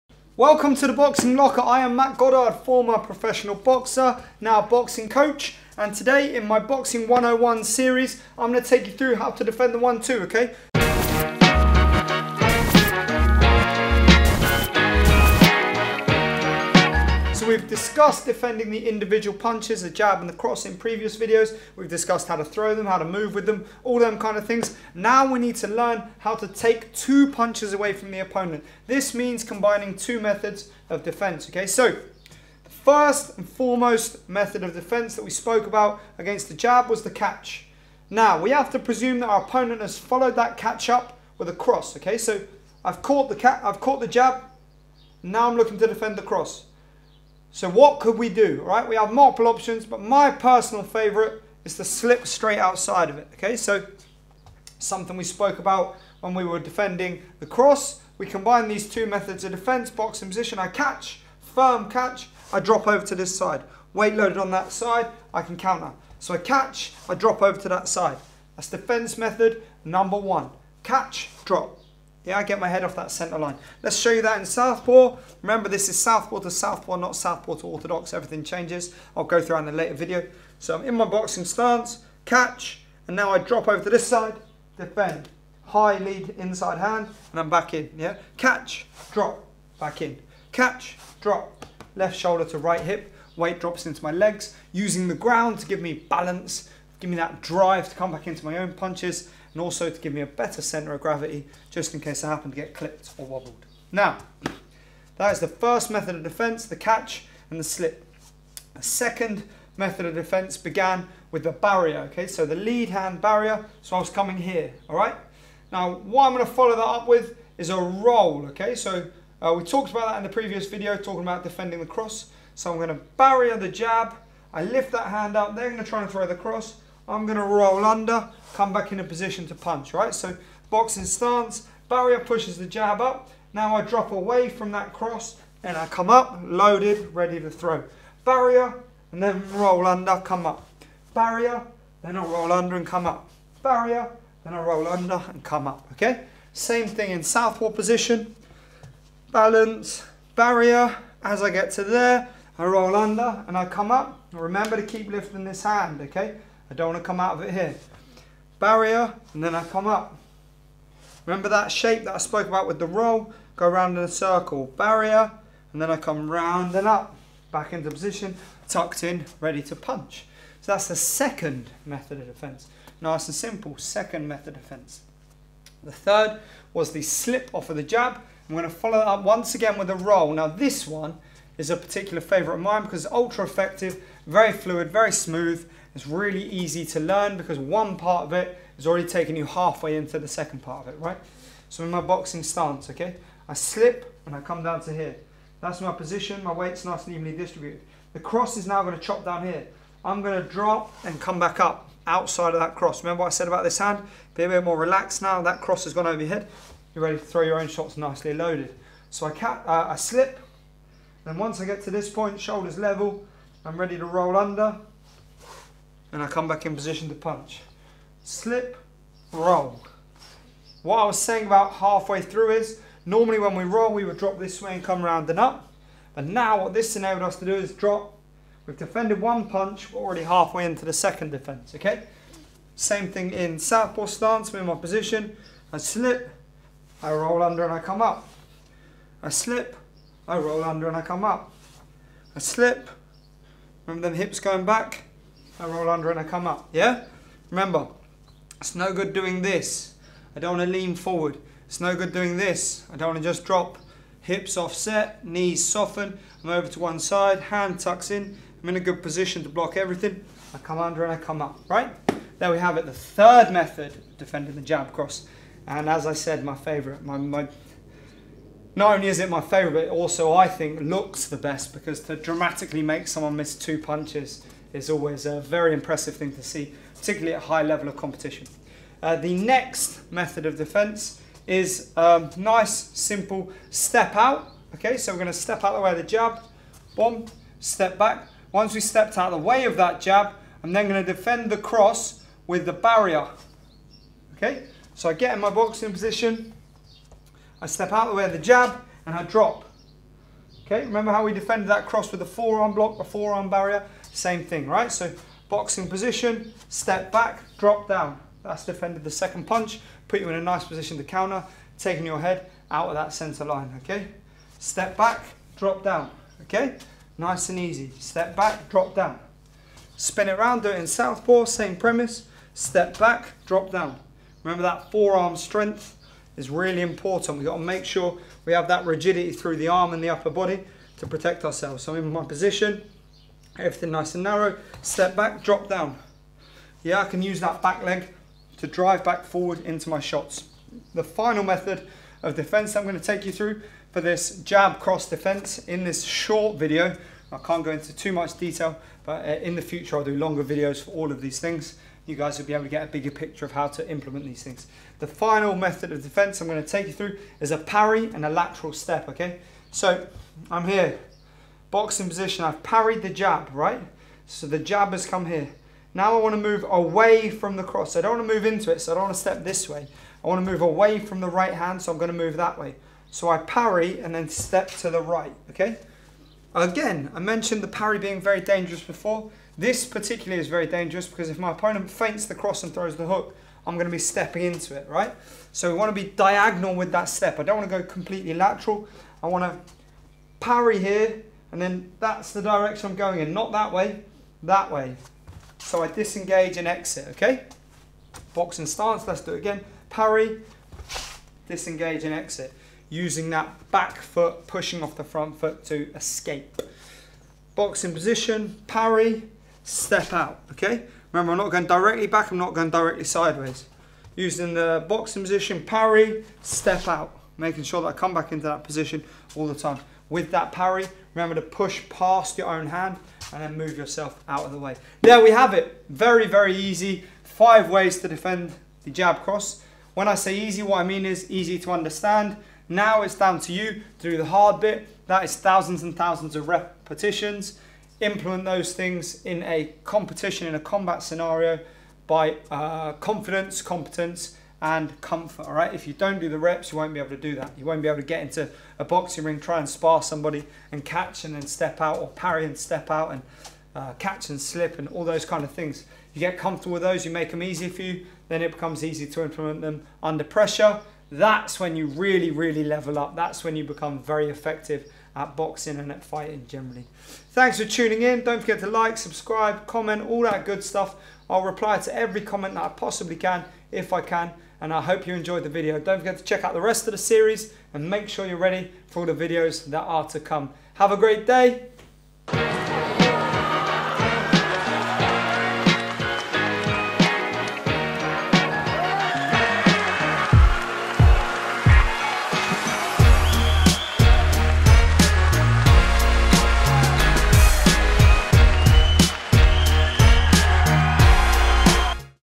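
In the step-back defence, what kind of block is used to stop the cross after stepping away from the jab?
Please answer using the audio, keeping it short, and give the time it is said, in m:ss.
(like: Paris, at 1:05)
forearm block, at 5:02.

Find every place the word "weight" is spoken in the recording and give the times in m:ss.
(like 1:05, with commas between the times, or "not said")
1:03, 1:33, 3:16.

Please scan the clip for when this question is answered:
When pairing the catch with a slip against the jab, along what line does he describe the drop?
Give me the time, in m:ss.
1:31.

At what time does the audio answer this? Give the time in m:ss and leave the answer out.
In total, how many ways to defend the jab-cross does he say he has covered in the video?
7:07.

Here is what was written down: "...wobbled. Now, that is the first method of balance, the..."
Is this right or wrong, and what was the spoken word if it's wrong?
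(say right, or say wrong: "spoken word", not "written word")
wrong: "defence", not "balance".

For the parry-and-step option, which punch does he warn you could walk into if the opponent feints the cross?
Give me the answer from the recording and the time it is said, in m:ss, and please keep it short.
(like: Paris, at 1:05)
the hook, at 6:22.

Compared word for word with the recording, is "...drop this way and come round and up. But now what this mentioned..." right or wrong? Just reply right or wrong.
wrong.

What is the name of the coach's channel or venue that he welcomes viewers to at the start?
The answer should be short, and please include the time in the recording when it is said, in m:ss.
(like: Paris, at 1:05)
Boxing Locker, at 0:00.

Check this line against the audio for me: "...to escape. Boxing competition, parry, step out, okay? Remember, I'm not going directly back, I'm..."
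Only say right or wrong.
wrong.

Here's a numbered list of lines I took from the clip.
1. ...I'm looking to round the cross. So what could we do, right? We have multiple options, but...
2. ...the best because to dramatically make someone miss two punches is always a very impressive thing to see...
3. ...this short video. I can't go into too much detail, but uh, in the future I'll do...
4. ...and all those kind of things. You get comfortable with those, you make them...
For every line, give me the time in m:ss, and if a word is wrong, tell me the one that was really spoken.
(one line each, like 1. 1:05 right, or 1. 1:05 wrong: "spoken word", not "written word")
1. 0:45 wrong: "defend", not "round"
2. 4:31 right
3. 5:45 right
4. 7:34 right.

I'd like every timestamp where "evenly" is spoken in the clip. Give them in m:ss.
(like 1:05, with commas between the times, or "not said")
3:17.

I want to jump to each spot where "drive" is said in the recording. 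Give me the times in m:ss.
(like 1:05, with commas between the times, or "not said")
1:37, 5:38.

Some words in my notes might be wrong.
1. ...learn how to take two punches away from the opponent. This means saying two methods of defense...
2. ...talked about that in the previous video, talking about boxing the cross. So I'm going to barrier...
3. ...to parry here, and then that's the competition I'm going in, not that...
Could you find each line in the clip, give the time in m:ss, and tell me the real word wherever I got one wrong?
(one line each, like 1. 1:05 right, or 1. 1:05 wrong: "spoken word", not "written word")
1. 0:25 wrong: "combining", not "saying"
2. 1:59 wrong: "defending", not "boxing"
3. 6:29 wrong: "direction", not "competition".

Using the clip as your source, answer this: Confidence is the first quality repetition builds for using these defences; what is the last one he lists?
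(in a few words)
comfort.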